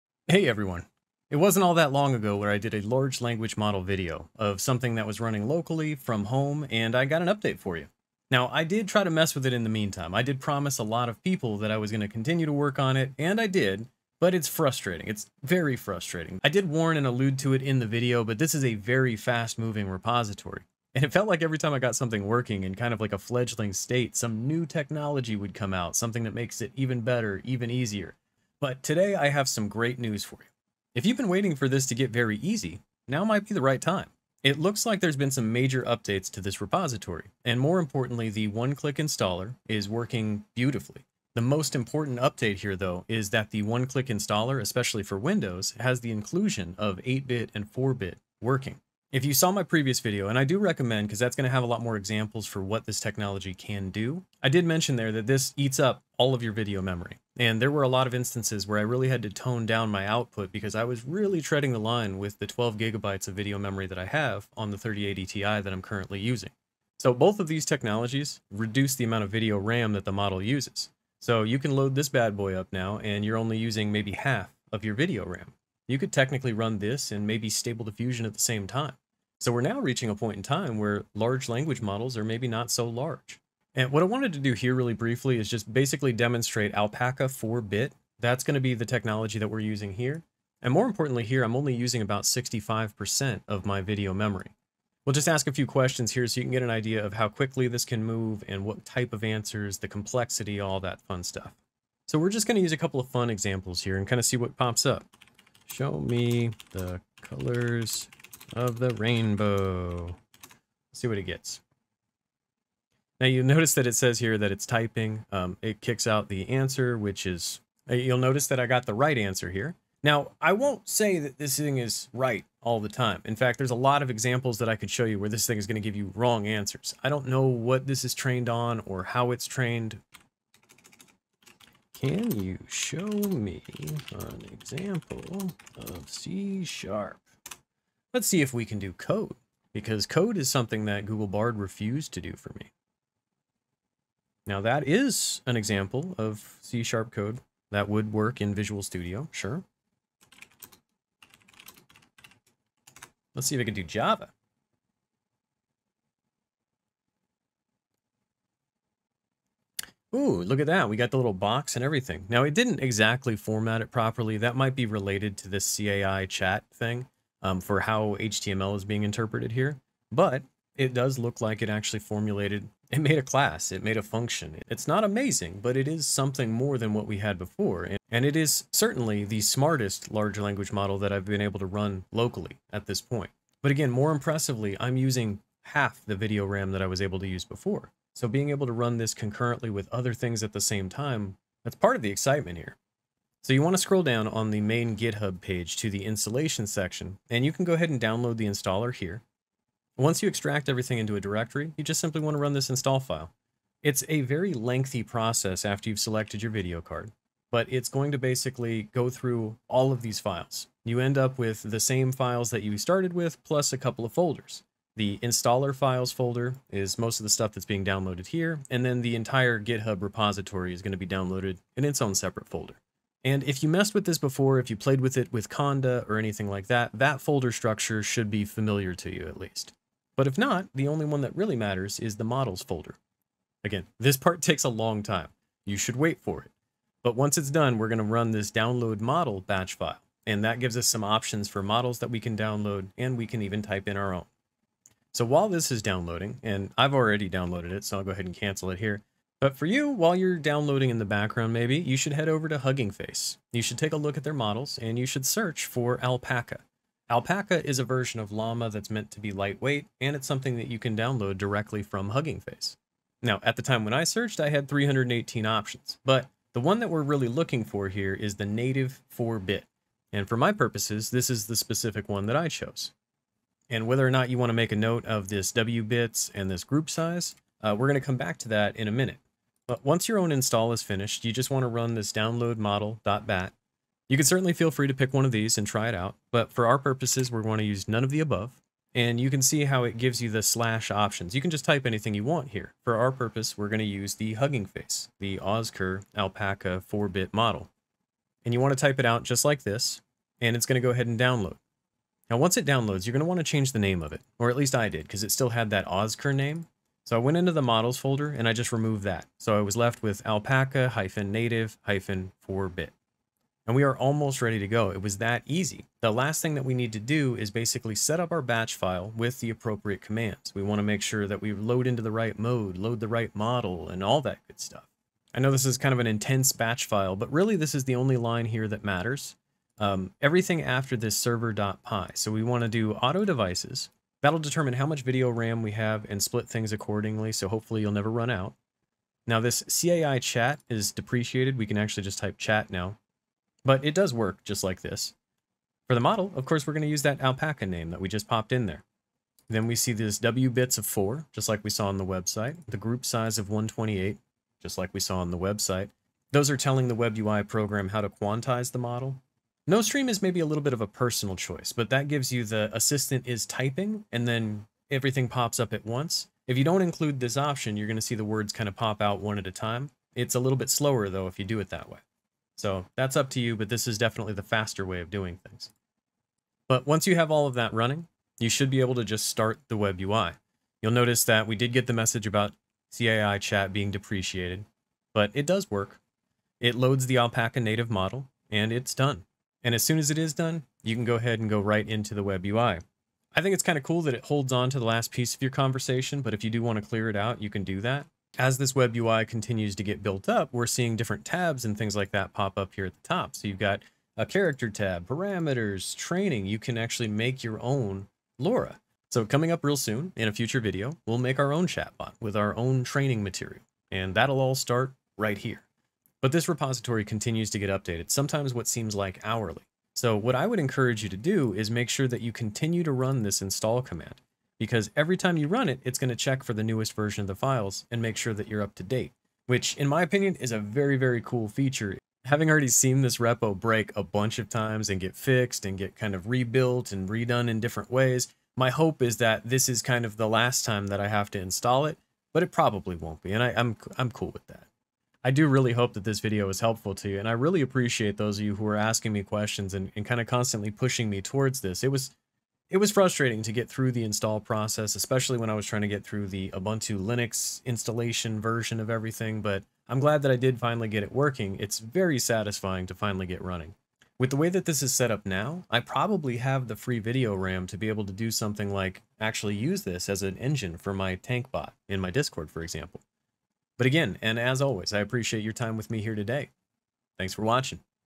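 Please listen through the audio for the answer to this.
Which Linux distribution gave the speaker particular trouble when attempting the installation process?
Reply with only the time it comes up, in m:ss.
7:36.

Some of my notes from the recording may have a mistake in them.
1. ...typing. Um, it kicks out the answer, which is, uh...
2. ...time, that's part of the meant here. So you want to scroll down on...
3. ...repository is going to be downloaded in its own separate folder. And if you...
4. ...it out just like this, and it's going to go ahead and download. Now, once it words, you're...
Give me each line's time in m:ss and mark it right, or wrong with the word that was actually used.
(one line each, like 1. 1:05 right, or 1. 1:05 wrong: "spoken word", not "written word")
1. 1:54 right
2. 3:10 wrong: "excitement", not "meant"
3. 3:40 right
4. 4:58 wrong: "downloads", not "words".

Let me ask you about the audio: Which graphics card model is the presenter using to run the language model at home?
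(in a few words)
3080 Ti.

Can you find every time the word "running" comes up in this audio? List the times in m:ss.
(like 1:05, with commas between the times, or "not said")
0:05, 6:17, 7:43.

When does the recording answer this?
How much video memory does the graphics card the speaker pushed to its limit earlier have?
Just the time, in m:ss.
1:02.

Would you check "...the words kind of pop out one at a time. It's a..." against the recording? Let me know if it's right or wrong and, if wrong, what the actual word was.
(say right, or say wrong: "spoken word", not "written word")
right.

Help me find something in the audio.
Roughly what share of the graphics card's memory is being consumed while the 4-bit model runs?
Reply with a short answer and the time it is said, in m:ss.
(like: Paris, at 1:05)
65%, at 1:32.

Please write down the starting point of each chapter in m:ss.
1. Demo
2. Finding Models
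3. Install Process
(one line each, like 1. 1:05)
1. 1:20
2. 4:09
3. 3:12.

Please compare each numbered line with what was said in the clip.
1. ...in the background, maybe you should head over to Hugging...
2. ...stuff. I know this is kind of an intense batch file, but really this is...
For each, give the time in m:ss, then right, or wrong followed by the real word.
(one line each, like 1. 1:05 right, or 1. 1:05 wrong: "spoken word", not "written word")
1. 4:10 right
2. 5:24 right.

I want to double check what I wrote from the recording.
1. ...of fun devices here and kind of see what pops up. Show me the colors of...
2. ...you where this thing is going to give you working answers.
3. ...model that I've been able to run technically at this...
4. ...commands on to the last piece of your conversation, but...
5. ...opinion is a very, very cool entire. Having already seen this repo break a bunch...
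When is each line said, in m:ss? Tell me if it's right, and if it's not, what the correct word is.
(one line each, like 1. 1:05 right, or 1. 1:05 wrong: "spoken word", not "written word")
1. 1:42 wrong: "examples", not "devices"
2. 2:05 wrong: "wrong", not "working"
3. 3:00 wrong: "locally", not "technically"
4. 6:34 wrong: "holds", not "commands"
5. 7:10 wrong: "feature", not "entire".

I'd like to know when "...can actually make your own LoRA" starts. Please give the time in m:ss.
6:46.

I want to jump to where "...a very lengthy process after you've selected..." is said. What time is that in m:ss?
3:24.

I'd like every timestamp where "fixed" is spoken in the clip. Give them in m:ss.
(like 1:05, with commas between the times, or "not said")
7:15.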